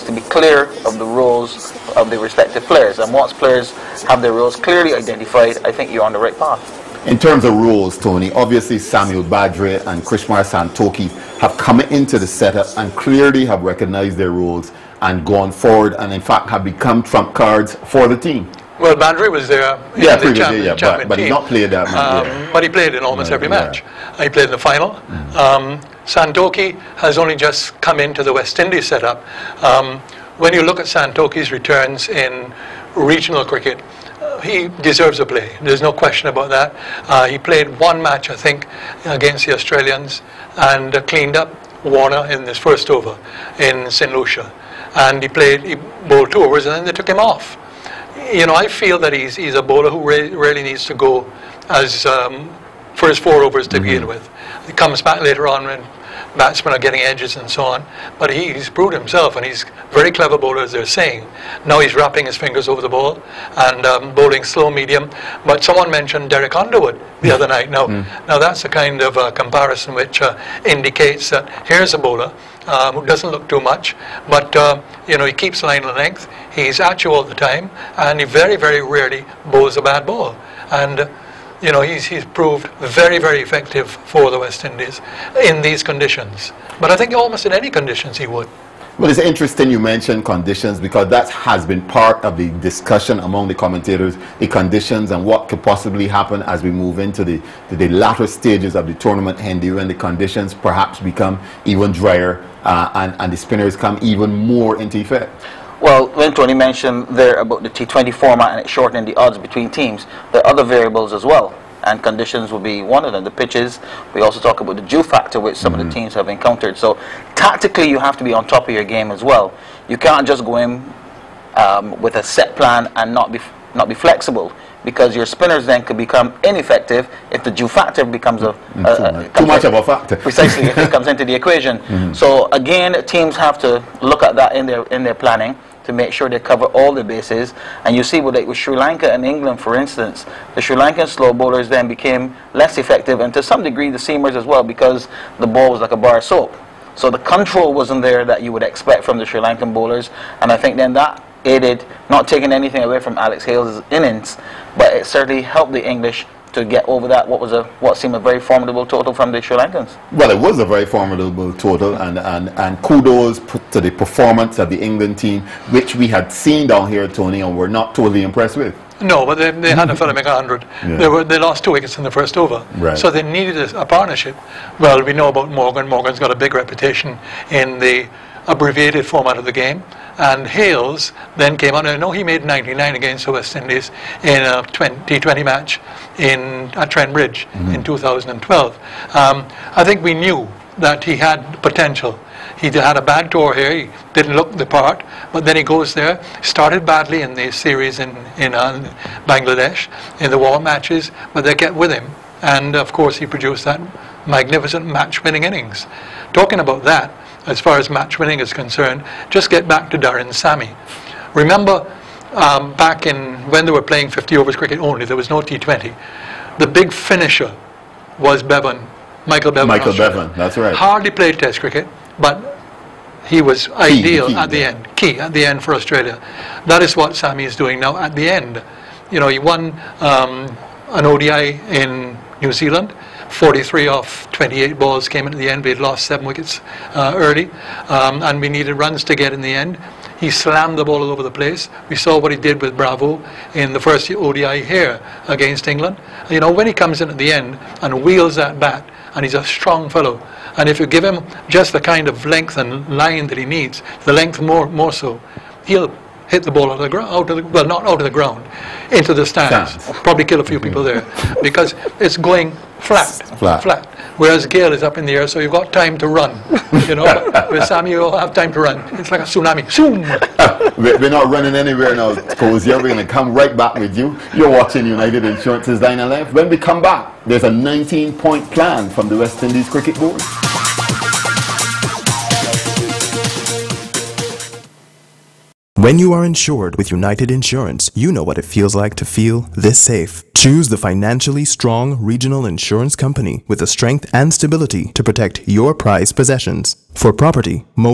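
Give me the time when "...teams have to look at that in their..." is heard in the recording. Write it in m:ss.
2:13.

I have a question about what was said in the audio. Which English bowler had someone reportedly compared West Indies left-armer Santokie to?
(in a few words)
Derek Underwood.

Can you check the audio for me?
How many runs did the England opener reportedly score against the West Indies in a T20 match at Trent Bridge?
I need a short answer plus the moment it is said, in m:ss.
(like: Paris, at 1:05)
99, at 3:02.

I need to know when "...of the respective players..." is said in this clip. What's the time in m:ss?
0:01.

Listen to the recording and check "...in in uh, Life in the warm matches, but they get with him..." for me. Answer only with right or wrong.
wrong.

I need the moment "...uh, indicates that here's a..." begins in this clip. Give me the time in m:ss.
1:10.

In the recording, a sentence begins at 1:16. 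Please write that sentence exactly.
He's at you all the time, and he very, very rarely bowls a bad ball.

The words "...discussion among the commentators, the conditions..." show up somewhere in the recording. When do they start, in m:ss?
1:32.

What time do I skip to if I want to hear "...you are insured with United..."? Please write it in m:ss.
4:45.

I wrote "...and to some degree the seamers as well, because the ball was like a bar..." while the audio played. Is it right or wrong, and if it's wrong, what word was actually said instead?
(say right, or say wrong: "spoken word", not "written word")
right.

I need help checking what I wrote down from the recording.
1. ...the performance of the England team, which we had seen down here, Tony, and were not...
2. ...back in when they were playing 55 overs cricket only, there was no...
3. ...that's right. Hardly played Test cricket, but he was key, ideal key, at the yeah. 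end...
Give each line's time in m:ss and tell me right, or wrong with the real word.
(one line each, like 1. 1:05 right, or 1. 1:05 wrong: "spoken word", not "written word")
1. 2:43 right
2. 3:32 wrong: "50", not "55"
3. 3:40 right.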